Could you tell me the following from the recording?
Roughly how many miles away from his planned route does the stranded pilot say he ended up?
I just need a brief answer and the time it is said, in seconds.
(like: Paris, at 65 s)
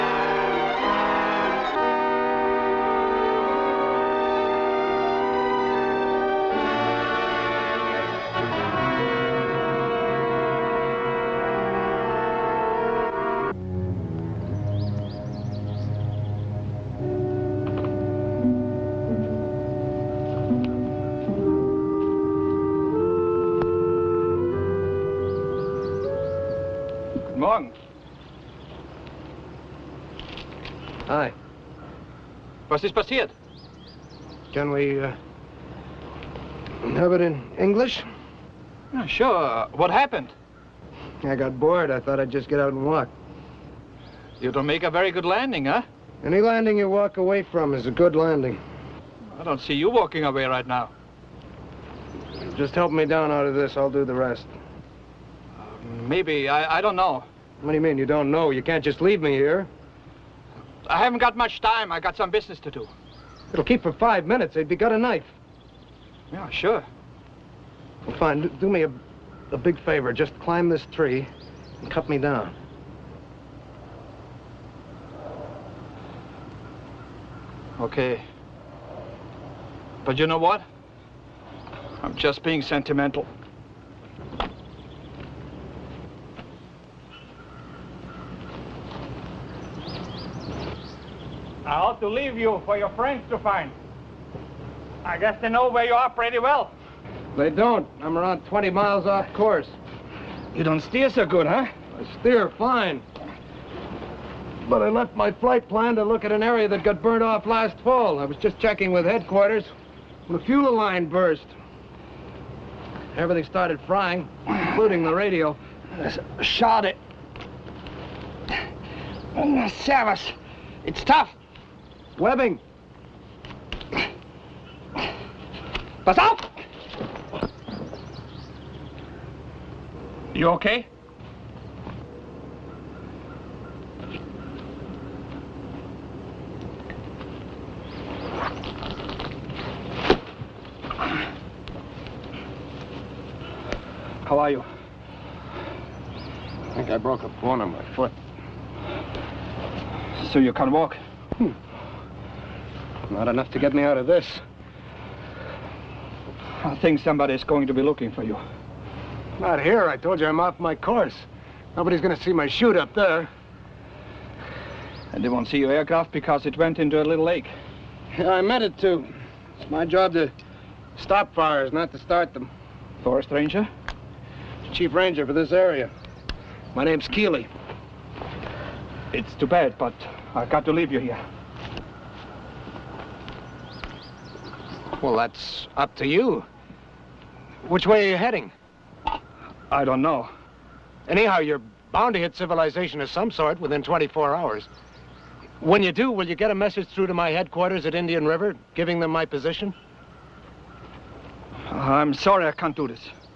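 20 miles, at 98 s.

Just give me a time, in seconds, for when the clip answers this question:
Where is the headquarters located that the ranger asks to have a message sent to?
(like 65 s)
197 s.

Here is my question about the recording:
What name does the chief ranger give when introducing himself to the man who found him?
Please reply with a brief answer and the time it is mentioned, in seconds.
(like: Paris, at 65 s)
Keeley, at 177 s.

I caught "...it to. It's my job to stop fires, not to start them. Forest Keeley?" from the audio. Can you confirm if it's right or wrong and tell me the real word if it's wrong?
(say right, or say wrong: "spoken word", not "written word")
wrong: "Ranger", not "Keeley".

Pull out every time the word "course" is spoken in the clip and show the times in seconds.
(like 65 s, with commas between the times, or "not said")
99 s, 160 s.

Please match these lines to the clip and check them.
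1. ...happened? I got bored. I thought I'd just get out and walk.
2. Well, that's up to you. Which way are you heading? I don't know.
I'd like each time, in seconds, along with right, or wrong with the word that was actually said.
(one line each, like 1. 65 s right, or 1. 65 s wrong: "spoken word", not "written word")
1. 39 s right
2. 185 s right.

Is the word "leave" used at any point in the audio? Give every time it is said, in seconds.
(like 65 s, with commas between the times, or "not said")
59 s, 92 s, 180 s.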